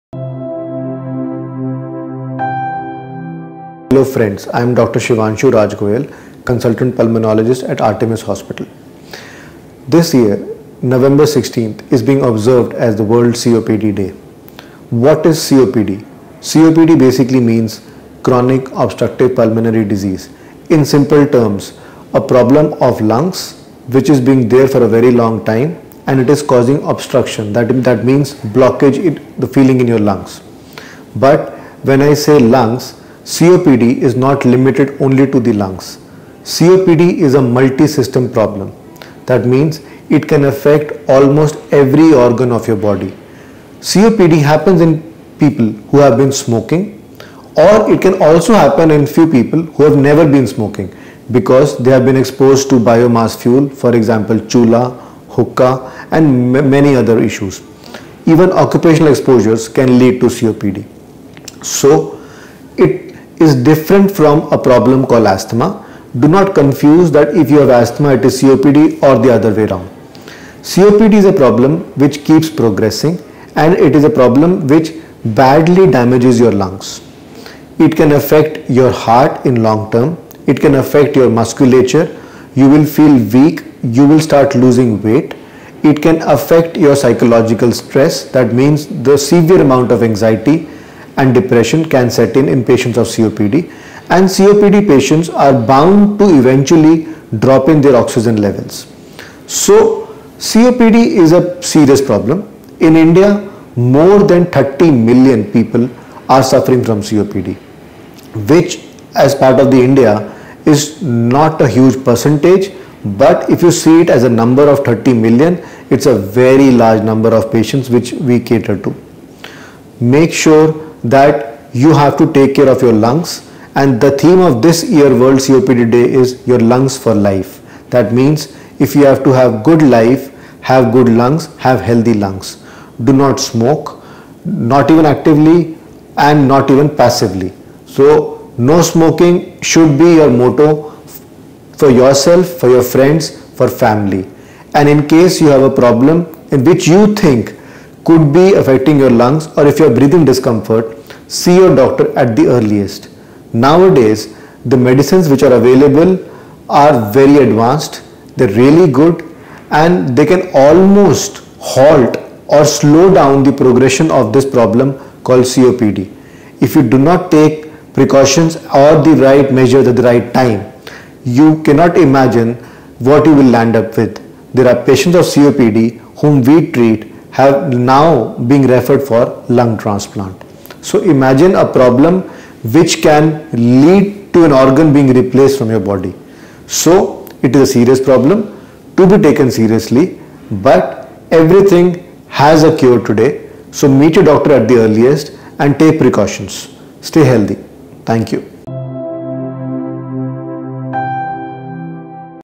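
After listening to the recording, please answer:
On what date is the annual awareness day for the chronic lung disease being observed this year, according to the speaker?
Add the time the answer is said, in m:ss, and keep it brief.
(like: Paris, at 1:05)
November 16, at 0:10.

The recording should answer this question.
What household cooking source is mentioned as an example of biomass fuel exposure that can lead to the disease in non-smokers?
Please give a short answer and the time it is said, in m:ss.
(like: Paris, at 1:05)
Chula, at 0:54.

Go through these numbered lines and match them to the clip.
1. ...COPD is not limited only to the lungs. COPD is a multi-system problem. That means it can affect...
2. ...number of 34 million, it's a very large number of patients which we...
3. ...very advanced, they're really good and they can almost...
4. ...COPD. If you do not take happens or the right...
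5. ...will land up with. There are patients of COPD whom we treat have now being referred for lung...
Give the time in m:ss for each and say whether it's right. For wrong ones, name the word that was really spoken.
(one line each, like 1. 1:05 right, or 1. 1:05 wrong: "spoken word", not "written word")
1. 0:33 right
2. 1:54 wrong: "30", not "34"
3. 2:37 right
4. 2:45 wrong: "precautions", not "happens"
5. 2:53 right.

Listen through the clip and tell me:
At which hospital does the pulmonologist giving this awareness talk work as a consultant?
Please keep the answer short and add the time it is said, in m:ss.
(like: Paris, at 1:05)
Artemis Hospital, at 0:07.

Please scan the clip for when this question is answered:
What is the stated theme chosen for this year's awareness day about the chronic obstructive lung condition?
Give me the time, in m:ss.
2:06.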